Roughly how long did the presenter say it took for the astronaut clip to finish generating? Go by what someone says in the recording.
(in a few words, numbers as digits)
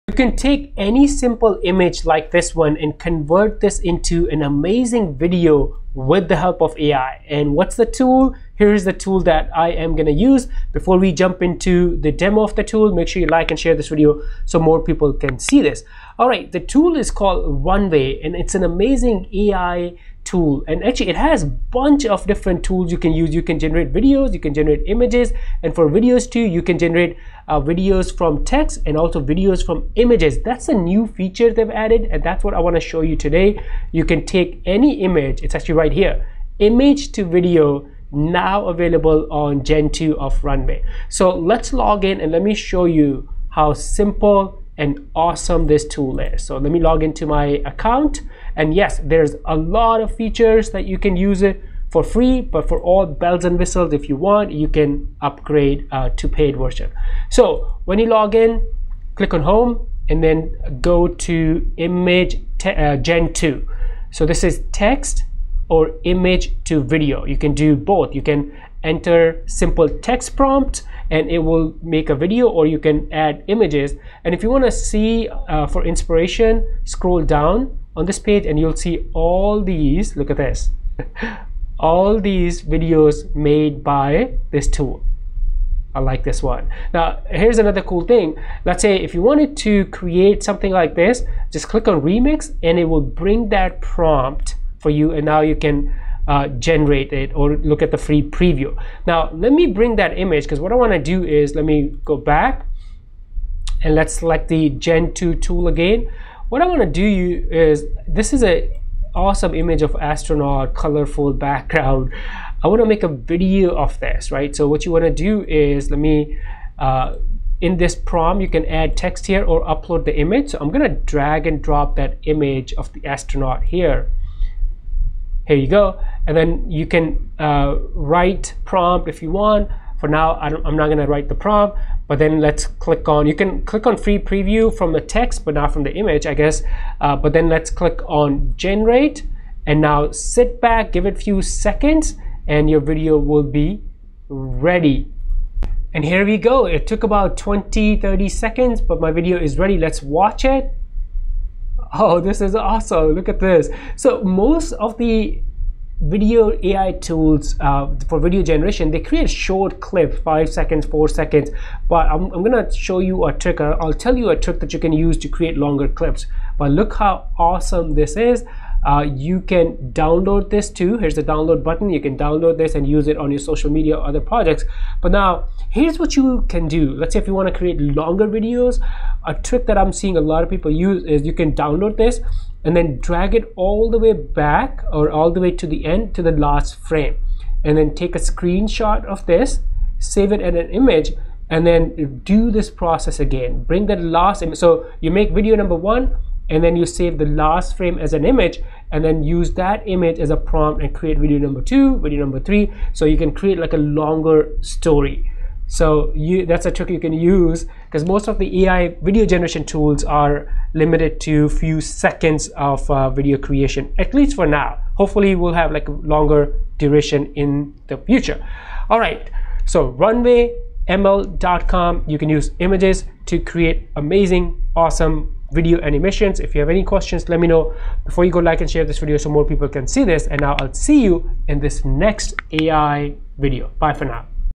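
20 30 seconds.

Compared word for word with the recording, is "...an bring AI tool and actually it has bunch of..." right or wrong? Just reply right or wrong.
wrong.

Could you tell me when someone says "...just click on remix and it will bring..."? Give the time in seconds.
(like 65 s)
91 s.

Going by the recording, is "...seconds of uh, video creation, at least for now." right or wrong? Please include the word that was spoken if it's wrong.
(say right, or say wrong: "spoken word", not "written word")
right.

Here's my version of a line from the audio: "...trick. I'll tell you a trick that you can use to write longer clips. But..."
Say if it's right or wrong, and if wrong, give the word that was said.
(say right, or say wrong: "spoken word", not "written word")
wrong: "create", not "write".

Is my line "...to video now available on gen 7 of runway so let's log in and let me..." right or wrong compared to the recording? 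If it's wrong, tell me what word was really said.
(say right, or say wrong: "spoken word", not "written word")
wrong: "2", not "7".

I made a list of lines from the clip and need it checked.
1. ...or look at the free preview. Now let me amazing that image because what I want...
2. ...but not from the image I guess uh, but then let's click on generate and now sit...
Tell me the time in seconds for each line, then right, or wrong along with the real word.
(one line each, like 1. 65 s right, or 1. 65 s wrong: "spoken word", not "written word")
1. 97 s wrong: "bring", not "amazing"
2. 135 s right.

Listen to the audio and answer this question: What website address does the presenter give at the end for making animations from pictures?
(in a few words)
runwayml.com.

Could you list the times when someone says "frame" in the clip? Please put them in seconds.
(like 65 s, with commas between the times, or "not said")
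186 s, 197 s.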